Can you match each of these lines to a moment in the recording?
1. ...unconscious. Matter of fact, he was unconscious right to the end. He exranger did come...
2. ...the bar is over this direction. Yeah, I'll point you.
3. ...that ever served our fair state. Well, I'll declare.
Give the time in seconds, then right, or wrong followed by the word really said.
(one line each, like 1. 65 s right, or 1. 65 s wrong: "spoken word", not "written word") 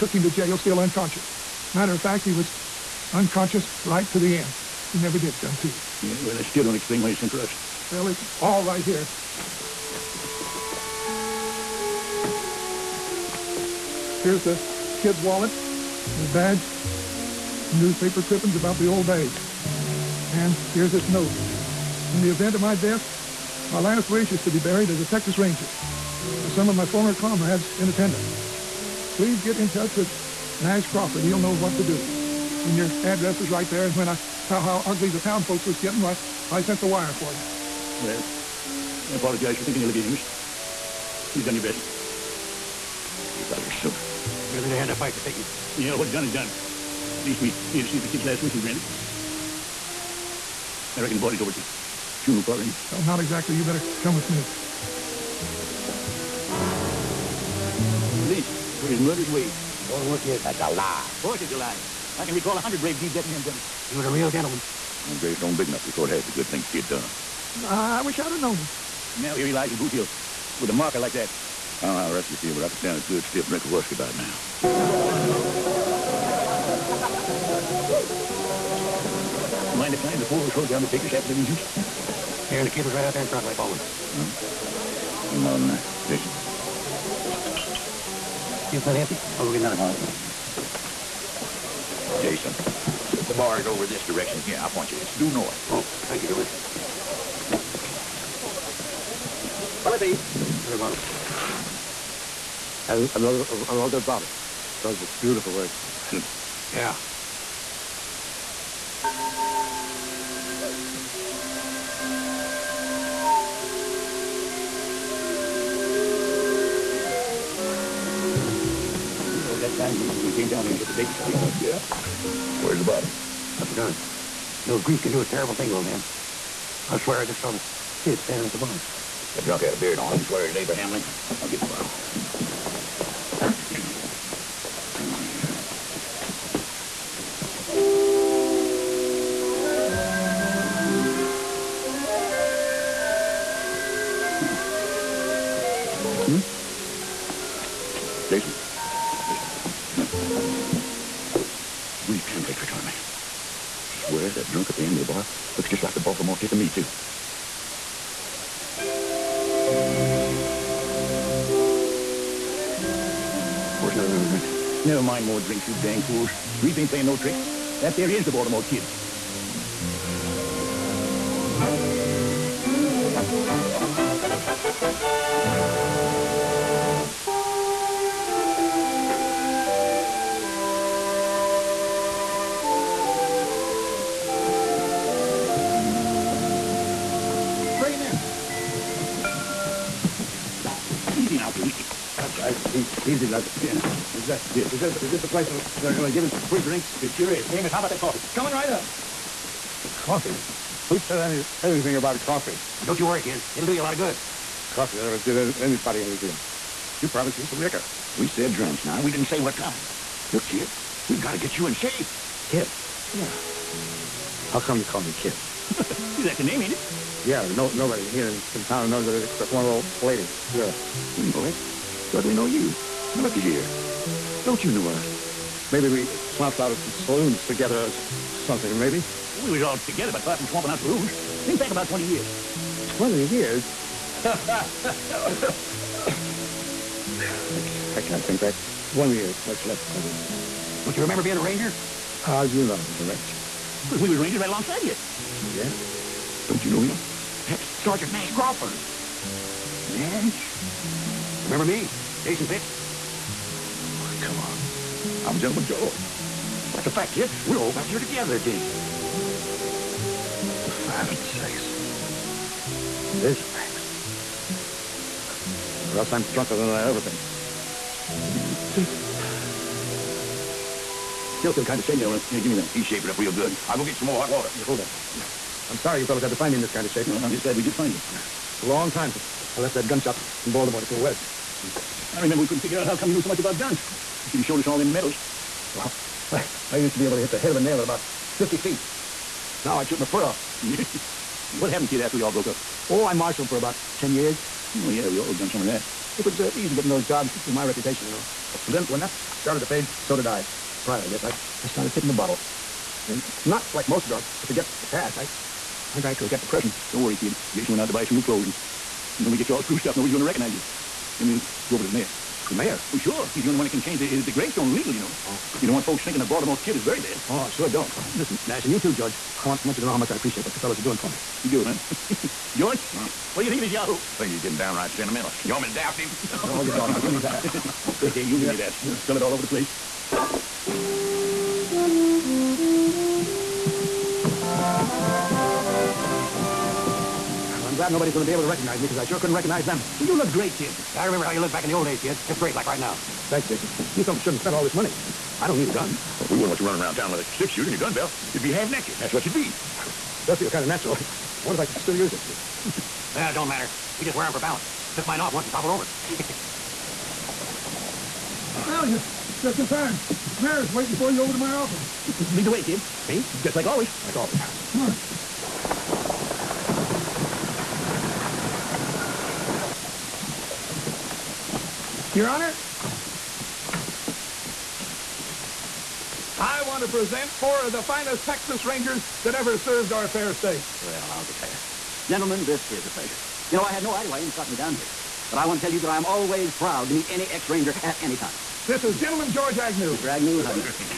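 1. 0 s wrong: "never", not "exranger"
2. 93 s right
3. 379 s right.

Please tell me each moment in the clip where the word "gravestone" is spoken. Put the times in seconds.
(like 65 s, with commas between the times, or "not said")
65 s, 314 s.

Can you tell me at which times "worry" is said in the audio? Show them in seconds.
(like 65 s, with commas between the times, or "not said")
203 s, 307 s.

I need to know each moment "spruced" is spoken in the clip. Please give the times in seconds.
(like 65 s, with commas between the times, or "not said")
309 s.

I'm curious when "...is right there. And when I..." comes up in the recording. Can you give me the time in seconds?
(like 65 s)
33 s.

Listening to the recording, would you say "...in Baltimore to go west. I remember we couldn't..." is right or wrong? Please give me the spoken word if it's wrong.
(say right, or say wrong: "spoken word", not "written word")
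right.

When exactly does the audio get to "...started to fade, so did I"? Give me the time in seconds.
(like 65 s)
299 s.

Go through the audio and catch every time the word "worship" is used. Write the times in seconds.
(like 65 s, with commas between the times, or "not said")
not said.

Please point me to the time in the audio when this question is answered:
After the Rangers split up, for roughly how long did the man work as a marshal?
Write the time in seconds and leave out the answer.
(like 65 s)
293 s.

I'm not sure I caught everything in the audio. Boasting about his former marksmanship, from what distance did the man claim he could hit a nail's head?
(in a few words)
50 feet.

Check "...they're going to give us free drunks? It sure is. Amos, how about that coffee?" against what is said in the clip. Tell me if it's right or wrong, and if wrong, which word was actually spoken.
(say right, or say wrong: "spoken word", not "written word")
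wrong: "drinks", not "drunks".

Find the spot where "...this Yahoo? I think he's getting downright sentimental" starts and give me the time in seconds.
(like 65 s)
323 s.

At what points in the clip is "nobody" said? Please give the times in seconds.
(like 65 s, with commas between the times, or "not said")
217 s, 309 s, 337 s.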